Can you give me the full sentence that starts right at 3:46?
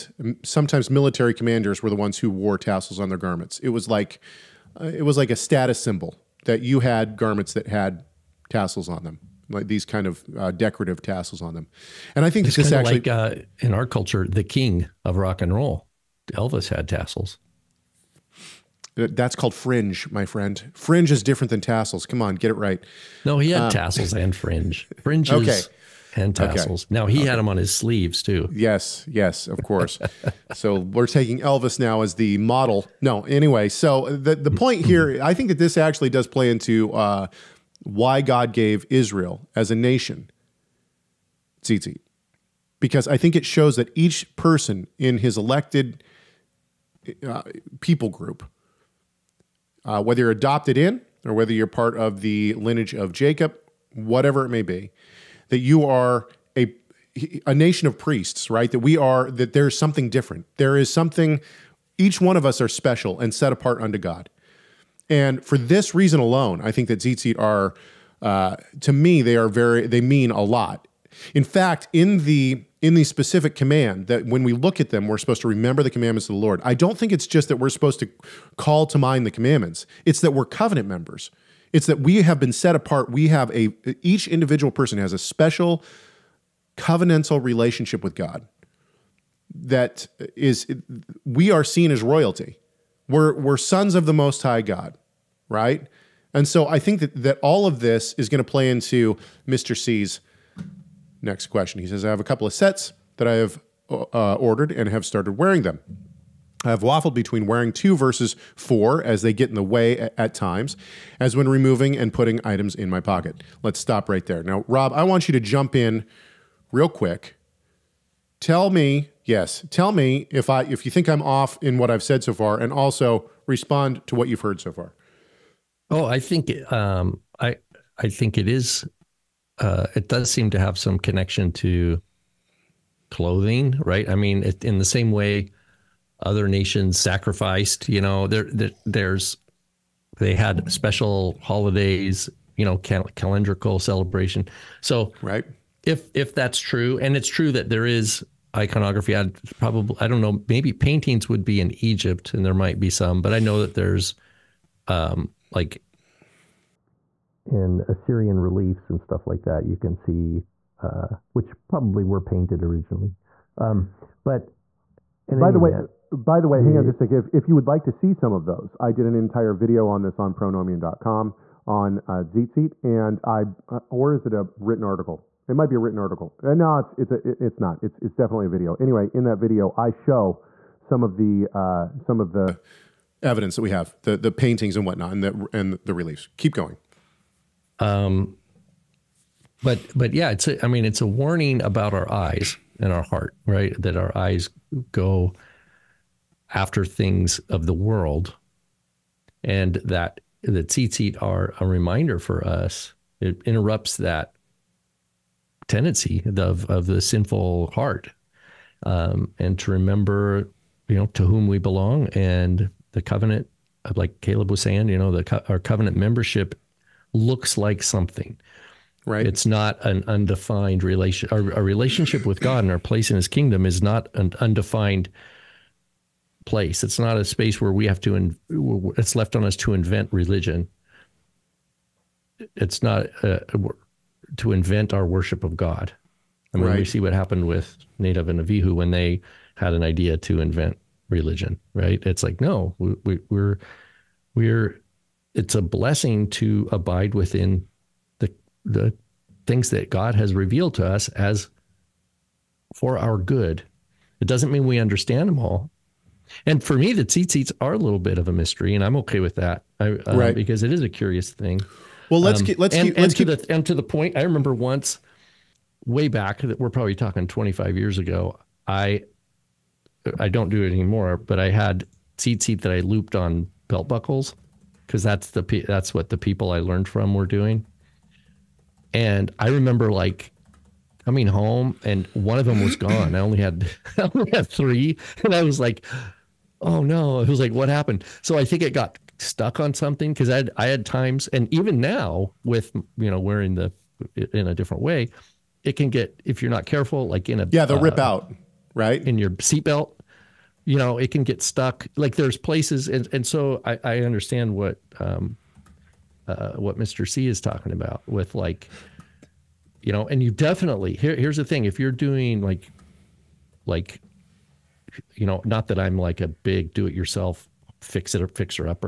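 It's not a space where we have to.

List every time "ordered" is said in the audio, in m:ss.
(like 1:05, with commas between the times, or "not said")
1:44.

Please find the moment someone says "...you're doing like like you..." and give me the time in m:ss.
5:11.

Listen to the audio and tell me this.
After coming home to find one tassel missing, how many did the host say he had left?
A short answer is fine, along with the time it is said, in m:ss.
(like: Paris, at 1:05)
3, at 4:44.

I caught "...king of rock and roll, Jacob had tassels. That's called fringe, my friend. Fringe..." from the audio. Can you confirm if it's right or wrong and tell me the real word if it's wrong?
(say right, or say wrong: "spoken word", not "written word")
wrong: "Elvis", not "Jacob".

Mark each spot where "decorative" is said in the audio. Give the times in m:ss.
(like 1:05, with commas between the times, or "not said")
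0:10.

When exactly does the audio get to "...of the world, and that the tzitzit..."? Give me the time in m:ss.
3:17.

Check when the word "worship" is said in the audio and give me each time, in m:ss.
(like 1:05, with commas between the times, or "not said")
3:55.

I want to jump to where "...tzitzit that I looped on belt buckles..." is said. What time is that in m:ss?
4:32.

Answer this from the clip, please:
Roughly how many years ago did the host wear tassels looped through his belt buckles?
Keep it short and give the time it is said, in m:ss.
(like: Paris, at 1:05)
25 years, at 4:27.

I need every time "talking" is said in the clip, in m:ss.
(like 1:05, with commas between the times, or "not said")
4:26, 5:07.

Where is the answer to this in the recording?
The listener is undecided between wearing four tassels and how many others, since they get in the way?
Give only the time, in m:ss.
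1:47.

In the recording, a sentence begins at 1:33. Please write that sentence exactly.
We're we're sons of the most high God right?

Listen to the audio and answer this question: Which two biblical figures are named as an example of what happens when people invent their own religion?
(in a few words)
Nadav and Avihu.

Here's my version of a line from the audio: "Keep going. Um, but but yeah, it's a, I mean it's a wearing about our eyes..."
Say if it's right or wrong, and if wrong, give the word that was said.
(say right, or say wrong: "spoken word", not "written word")
wrong: "warning", not "wearing".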